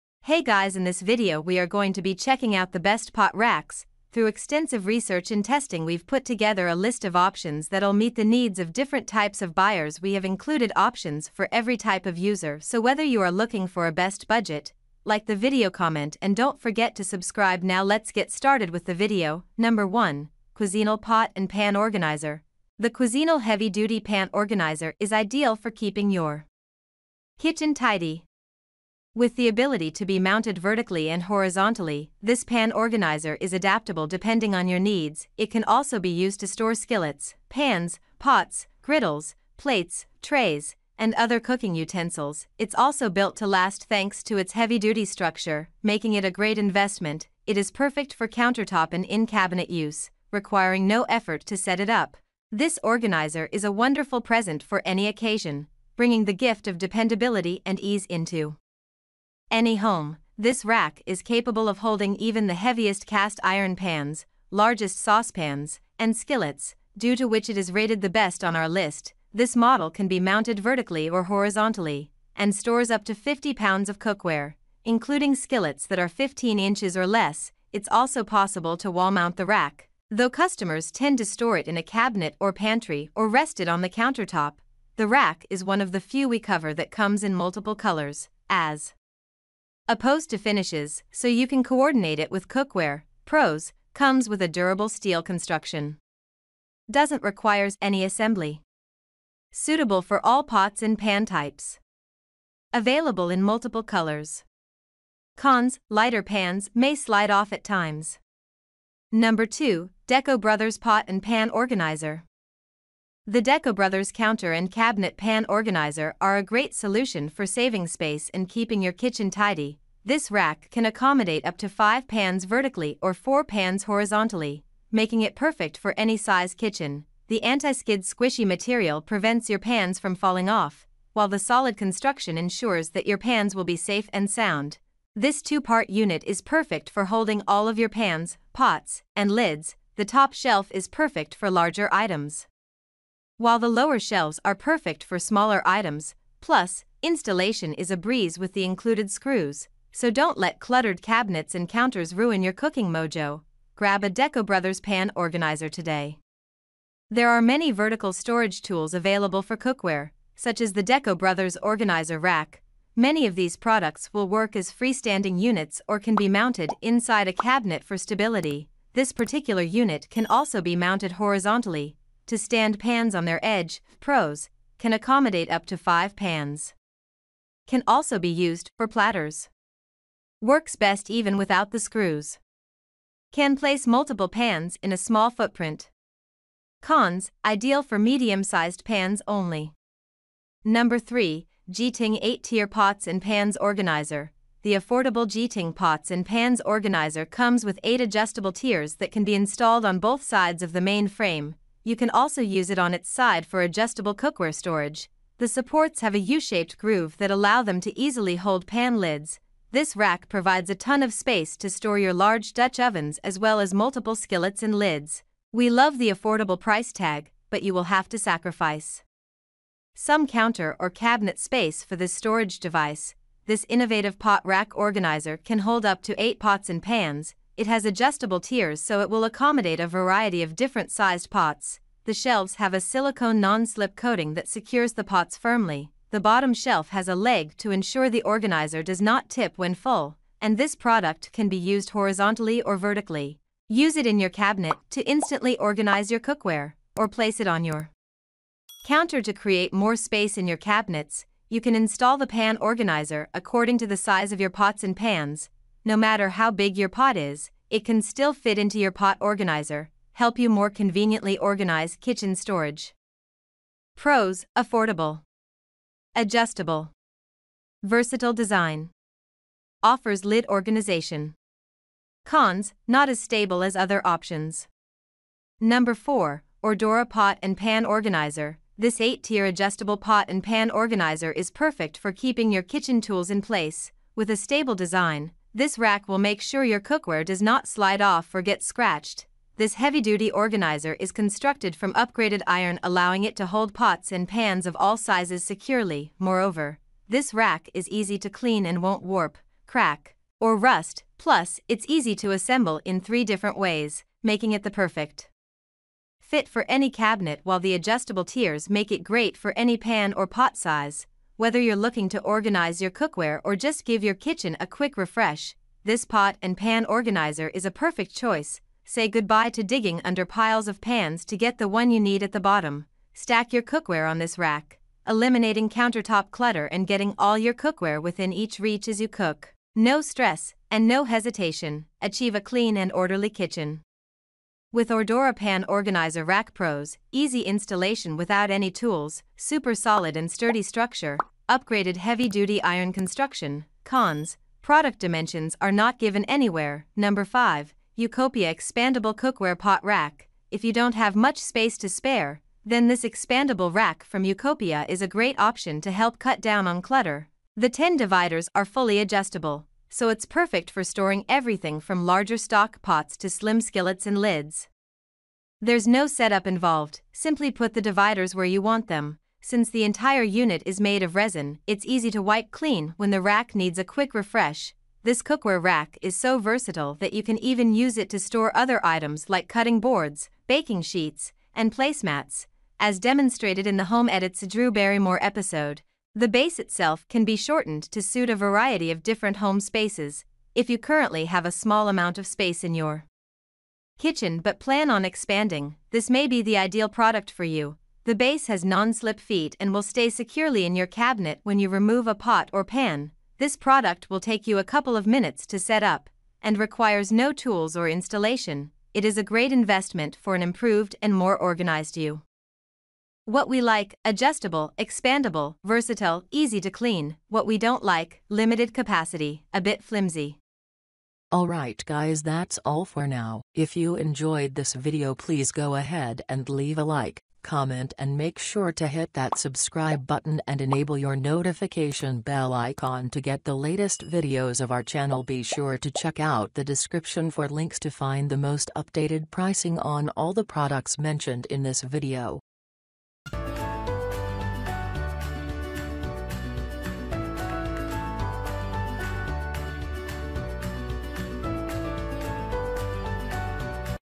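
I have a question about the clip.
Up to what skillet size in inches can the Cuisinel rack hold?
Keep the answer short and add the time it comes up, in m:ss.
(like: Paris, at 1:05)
15 inches, at 1:16.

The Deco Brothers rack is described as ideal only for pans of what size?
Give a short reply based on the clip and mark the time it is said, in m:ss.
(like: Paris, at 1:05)
medium-sized, at 3:07.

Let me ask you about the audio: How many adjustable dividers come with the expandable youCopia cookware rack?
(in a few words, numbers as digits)
10.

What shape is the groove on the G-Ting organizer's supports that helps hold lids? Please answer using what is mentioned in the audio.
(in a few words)
U-shaped.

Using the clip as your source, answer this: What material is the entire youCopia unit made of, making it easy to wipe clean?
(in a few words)
resin.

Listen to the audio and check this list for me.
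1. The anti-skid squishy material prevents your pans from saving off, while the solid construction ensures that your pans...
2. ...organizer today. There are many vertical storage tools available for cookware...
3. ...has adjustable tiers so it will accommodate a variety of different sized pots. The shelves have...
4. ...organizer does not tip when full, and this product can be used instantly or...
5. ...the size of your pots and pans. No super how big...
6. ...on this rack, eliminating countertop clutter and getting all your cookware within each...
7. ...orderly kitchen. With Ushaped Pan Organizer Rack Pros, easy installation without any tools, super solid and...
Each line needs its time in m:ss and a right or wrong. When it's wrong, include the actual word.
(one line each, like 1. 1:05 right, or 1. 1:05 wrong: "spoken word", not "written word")
1. 2:07 wrong: "falling", not "saving"
2. 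2:35 right
3. 3:47 right
4. 3:58 wrong: "horizontally", not "instantly"
5. 4:13 wrong: "matter", not "super"
6. 5:24 right
7. 5:32 wrong: "Ordora", not "Ushaped".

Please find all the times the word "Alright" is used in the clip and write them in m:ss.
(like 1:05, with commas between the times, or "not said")
7:01.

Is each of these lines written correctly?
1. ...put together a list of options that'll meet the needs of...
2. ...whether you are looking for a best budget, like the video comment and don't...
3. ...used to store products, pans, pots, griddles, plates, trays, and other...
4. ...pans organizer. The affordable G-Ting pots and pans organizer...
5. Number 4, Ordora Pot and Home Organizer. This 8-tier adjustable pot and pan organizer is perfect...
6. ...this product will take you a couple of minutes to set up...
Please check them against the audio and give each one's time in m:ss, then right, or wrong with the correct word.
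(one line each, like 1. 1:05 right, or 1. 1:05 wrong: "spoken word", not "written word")
1. 0:06 right
2. 0:12 right
3. 0:36 wrong: "skillets", not "products"
4. 3:13 right
5. 4:35 wrong: "Pan", not "Home"
6. 6:43 right.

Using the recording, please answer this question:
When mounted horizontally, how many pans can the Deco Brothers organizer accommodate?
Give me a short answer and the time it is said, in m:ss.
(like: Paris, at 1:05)
4, at 2:03.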